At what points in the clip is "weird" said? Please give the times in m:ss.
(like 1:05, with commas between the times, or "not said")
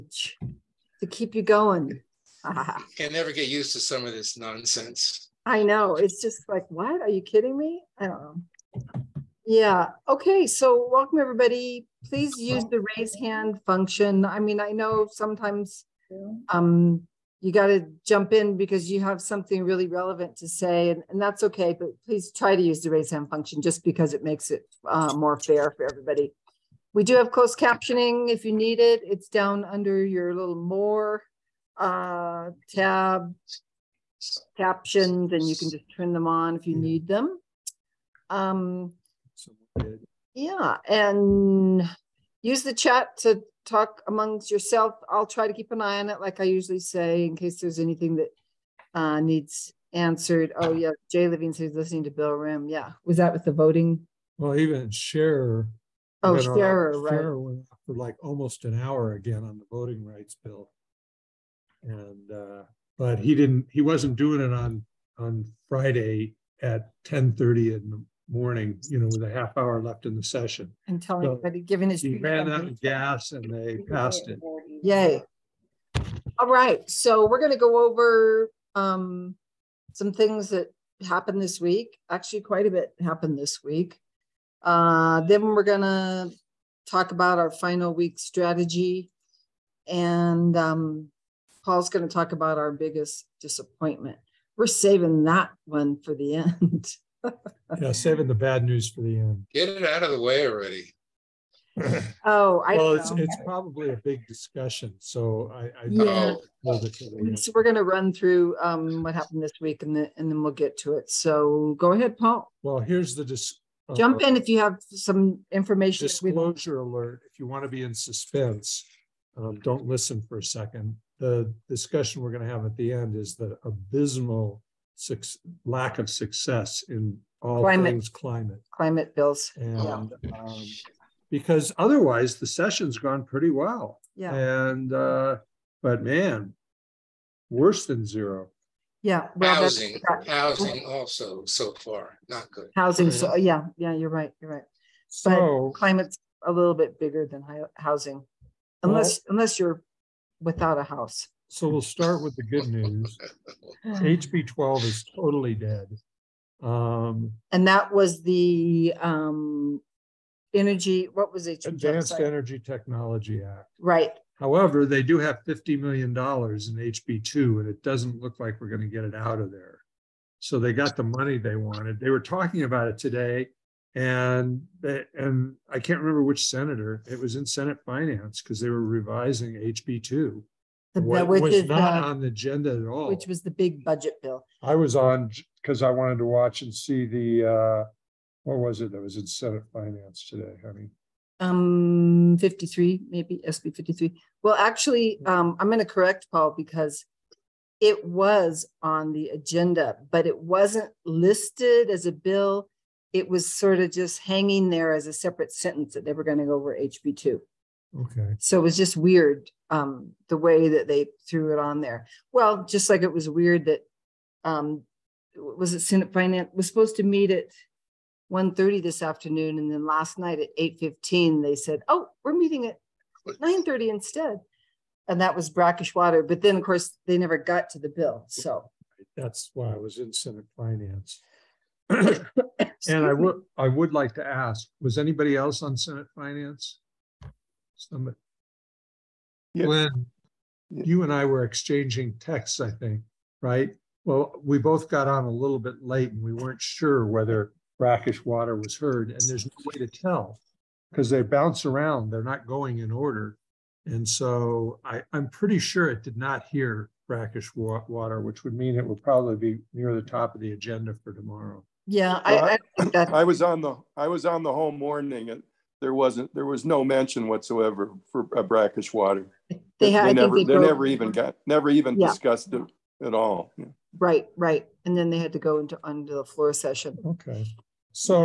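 3:28, 3:33.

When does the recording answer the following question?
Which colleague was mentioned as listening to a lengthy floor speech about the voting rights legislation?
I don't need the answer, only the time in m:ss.
0:51.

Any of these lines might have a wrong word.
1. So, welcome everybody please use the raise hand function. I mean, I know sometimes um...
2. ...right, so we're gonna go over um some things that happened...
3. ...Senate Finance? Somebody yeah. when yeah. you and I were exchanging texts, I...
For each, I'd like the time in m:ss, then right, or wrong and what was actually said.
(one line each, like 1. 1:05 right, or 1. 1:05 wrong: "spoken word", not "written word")
1. 0:10 right
2. 1:16 right
3. 3:55 right.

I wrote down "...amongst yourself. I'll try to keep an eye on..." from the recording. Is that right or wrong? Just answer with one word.
right.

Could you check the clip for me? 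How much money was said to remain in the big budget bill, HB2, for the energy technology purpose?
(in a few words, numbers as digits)
$50 million.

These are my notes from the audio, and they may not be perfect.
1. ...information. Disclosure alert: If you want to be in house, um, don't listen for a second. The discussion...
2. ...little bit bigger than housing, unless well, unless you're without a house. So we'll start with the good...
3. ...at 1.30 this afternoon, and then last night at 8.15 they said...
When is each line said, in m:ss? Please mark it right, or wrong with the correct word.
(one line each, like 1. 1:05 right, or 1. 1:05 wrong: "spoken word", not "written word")
1. 1:55 wrong: "suspense", not "house"
2. 2:26 right
3. 3:37 right.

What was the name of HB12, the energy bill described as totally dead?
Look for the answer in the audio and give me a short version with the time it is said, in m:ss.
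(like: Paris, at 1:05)
Advanced Energy Technology Act, at 2:41.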